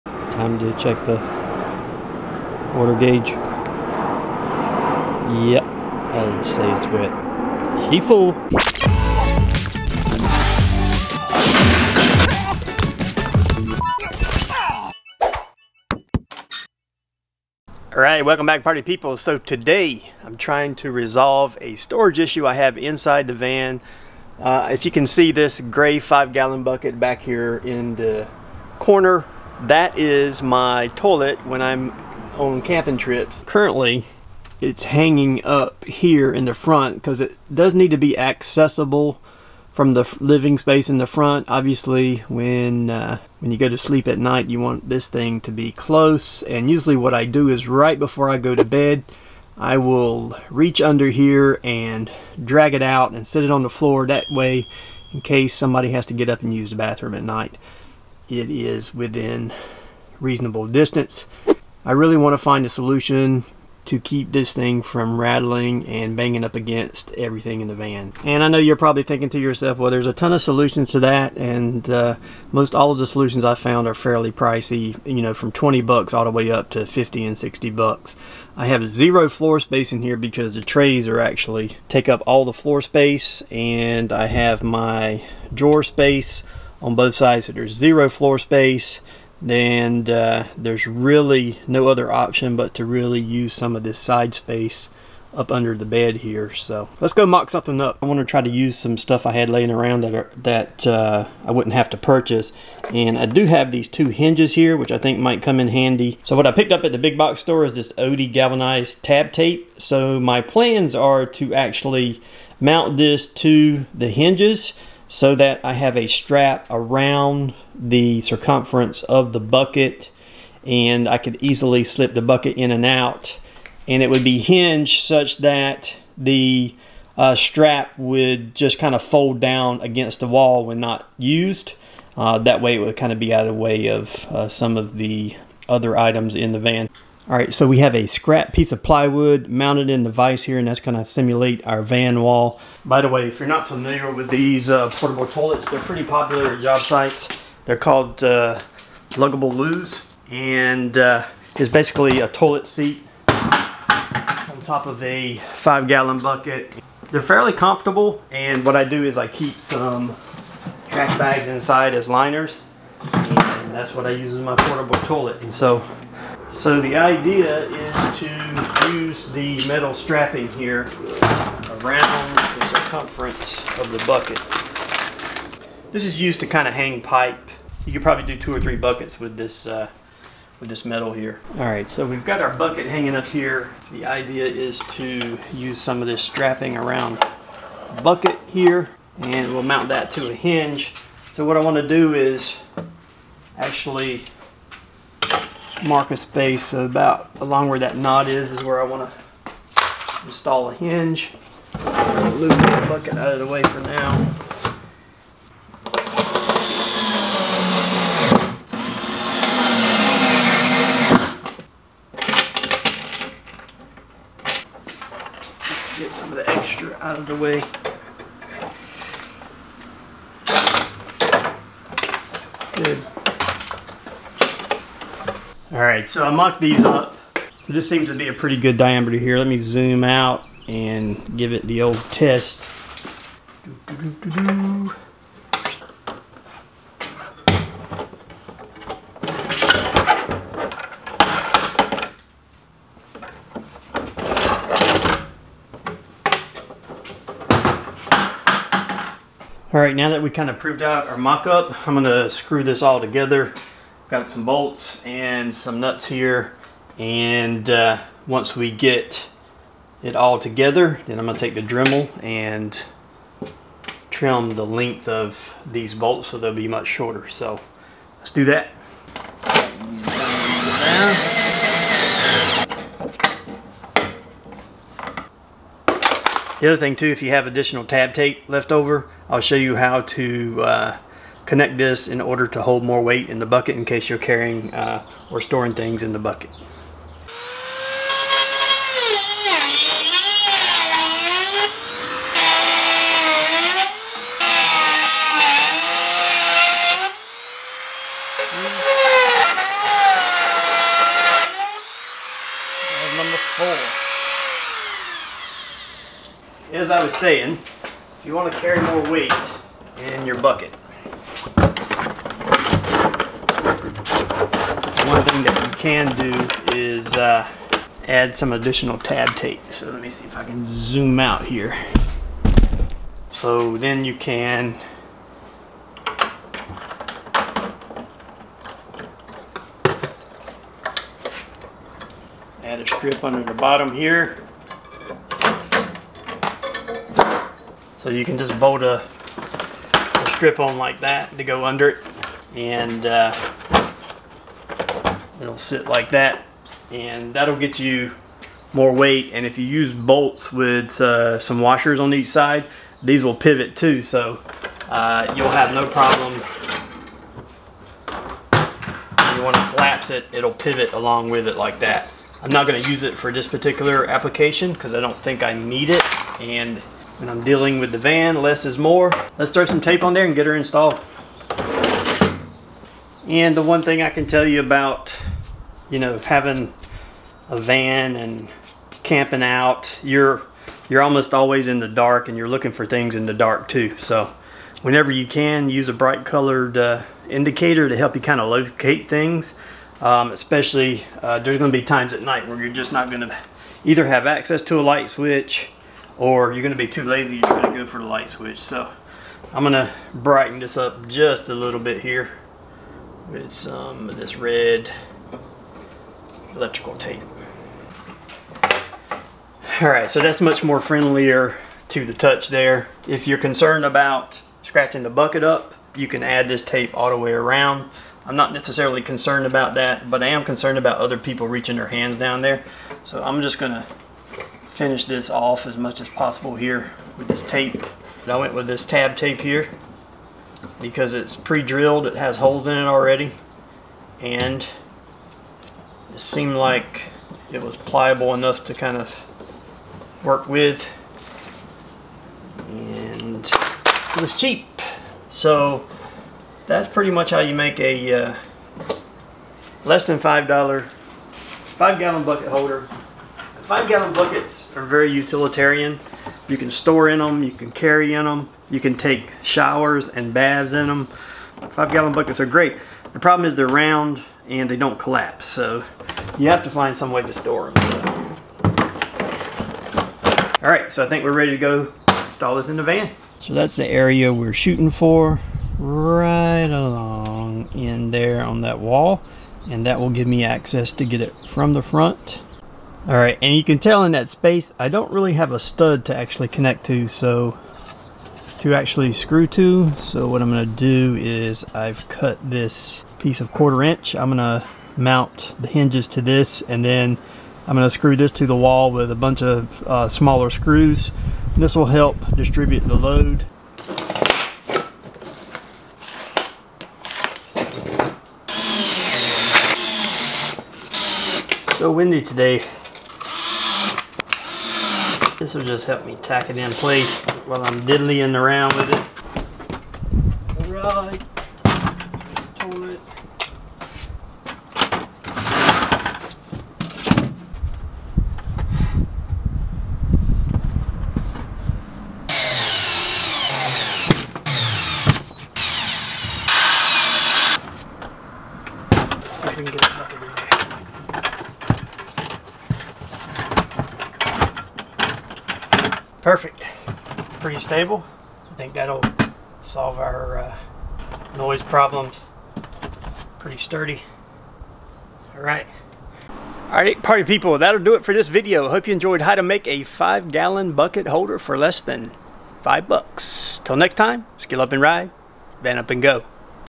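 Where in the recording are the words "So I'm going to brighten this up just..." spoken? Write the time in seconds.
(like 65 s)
398 s.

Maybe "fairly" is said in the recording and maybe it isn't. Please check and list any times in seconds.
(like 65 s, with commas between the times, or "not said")
73 s, 157 s.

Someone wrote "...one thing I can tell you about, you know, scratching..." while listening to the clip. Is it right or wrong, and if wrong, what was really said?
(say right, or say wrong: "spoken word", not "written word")
wrong: "having", not "scratching".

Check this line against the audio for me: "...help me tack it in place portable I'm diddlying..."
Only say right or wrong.
wrong.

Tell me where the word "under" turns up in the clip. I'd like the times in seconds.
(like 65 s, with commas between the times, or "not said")
50 s, 95 s, 333 s, 341 s.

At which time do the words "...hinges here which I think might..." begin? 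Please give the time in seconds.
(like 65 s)
104 s.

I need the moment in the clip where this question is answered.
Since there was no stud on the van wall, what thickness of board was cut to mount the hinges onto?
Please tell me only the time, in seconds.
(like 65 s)
493 s.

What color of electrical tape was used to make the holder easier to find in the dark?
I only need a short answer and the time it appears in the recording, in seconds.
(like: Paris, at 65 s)
red, at 404 s.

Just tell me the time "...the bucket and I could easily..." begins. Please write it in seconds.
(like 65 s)
119 s.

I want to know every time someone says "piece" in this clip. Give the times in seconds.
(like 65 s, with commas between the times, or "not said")
138 s, 493 s.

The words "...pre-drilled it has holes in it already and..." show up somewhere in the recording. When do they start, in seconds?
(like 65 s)
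431 s.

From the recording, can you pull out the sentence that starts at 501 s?
This will help distribute the load.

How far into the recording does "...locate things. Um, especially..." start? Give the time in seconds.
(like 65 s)
388 s.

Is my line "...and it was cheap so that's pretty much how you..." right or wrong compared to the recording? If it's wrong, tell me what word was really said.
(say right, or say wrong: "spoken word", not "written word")
right.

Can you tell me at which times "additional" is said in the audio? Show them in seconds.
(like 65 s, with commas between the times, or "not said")
277 s, 318 s.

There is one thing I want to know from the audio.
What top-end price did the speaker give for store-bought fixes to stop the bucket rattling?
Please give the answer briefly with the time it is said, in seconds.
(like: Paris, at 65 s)
60 bucks, at 77 s.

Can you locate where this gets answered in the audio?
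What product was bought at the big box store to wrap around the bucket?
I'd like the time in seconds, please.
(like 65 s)
108 s.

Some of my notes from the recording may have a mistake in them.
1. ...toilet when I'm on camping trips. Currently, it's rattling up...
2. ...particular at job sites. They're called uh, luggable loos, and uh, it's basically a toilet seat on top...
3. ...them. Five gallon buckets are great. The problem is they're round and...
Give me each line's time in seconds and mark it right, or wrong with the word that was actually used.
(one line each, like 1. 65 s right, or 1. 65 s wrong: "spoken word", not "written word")
1. 30 s wrong: "hanging", not "rattling"
2. 146 s wrong: "popular", not "particular"
3. 460 s right.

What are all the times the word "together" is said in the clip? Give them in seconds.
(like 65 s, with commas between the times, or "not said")
253 s, 260 s.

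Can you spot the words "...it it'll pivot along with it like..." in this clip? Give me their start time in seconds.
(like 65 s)
360 s.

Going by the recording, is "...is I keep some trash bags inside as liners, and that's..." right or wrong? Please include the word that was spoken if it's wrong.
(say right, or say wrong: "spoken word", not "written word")
right.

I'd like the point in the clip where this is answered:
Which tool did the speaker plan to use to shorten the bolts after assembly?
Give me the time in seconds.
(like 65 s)
261 s.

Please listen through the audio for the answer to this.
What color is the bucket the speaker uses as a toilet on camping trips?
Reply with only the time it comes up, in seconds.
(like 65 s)
25 s.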